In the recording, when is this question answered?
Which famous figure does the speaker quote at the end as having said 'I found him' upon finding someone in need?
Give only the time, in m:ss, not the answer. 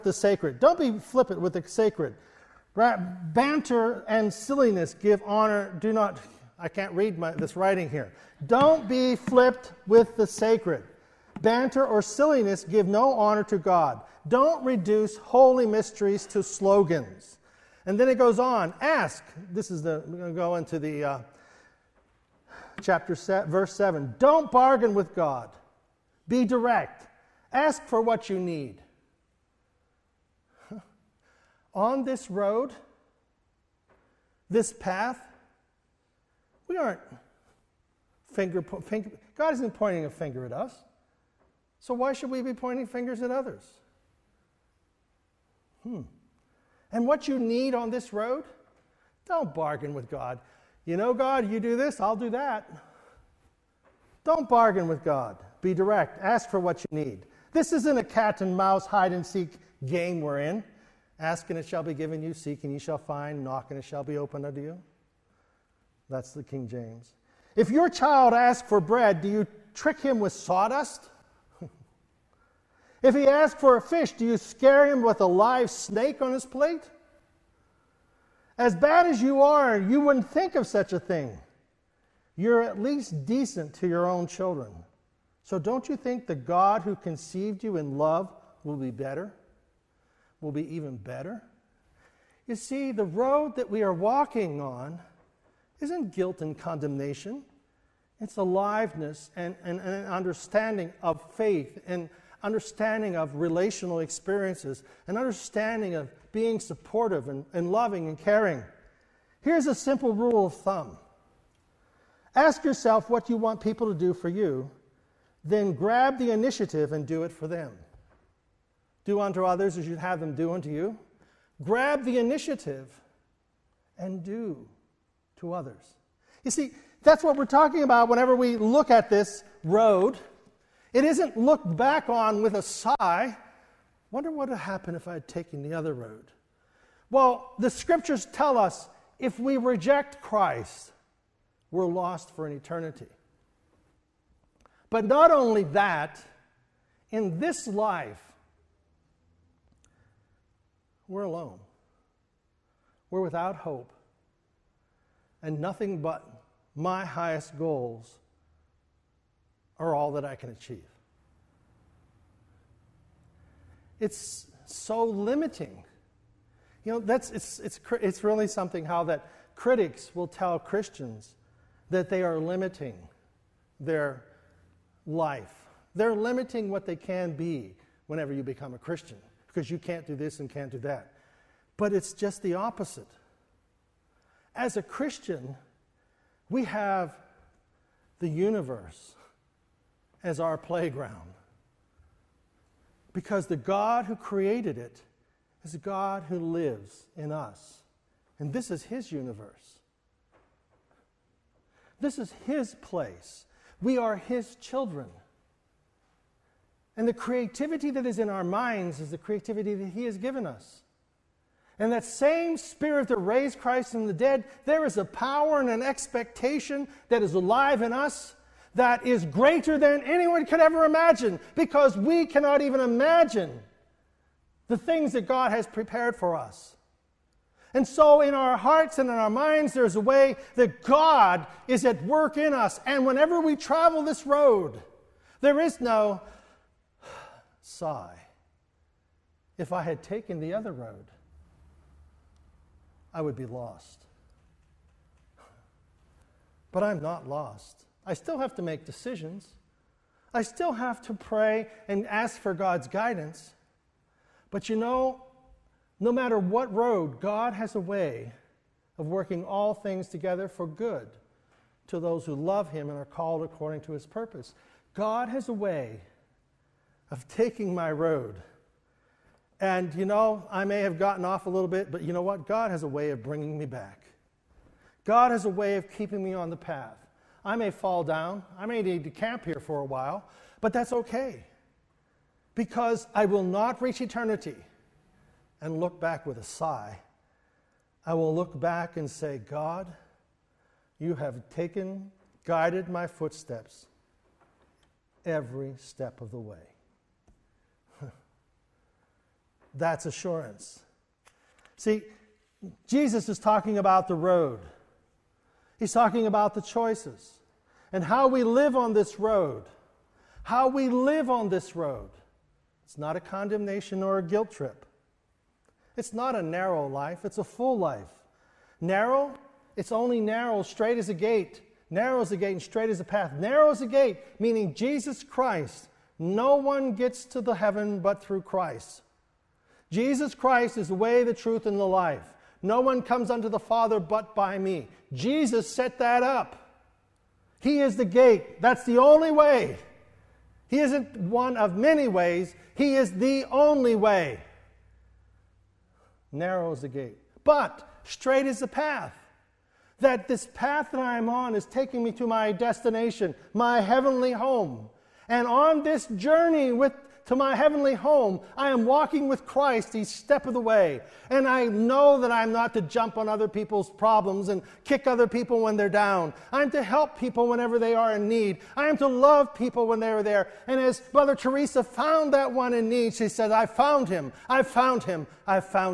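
6:11.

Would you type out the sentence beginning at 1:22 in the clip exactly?
You're at least decent to your own children.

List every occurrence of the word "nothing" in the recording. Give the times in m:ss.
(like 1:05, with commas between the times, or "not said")
2:35.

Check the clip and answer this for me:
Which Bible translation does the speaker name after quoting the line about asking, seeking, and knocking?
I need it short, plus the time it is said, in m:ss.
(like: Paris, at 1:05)
King James, at 1:06.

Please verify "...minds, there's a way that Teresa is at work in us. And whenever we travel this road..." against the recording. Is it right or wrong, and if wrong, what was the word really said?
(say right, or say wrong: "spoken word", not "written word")
wrong: "God", not "Teresa".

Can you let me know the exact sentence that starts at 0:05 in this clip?
Do not, I can't read my, this writing here.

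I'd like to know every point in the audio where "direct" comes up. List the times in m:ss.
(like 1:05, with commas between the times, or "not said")
0:26, 0:55.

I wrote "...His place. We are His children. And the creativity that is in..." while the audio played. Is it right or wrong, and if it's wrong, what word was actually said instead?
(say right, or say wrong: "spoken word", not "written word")
right.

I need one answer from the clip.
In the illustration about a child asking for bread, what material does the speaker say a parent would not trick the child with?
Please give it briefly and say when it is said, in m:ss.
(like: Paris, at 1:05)
Sawdust, at 1:10.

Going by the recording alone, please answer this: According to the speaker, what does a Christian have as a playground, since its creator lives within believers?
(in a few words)
The universe.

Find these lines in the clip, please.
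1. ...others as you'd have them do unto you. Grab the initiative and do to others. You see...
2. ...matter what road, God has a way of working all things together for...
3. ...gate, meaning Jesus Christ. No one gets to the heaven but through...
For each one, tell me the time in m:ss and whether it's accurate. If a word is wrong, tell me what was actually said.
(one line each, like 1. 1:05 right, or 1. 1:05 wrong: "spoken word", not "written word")
1. 1:59 right
2. 4:16 right
3. 5:23 right.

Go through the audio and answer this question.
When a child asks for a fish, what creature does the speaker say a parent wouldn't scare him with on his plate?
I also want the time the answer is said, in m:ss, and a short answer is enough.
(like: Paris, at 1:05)
A live snake, at 1:15.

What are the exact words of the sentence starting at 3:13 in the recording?
Because the God who created it is a God who lives in us.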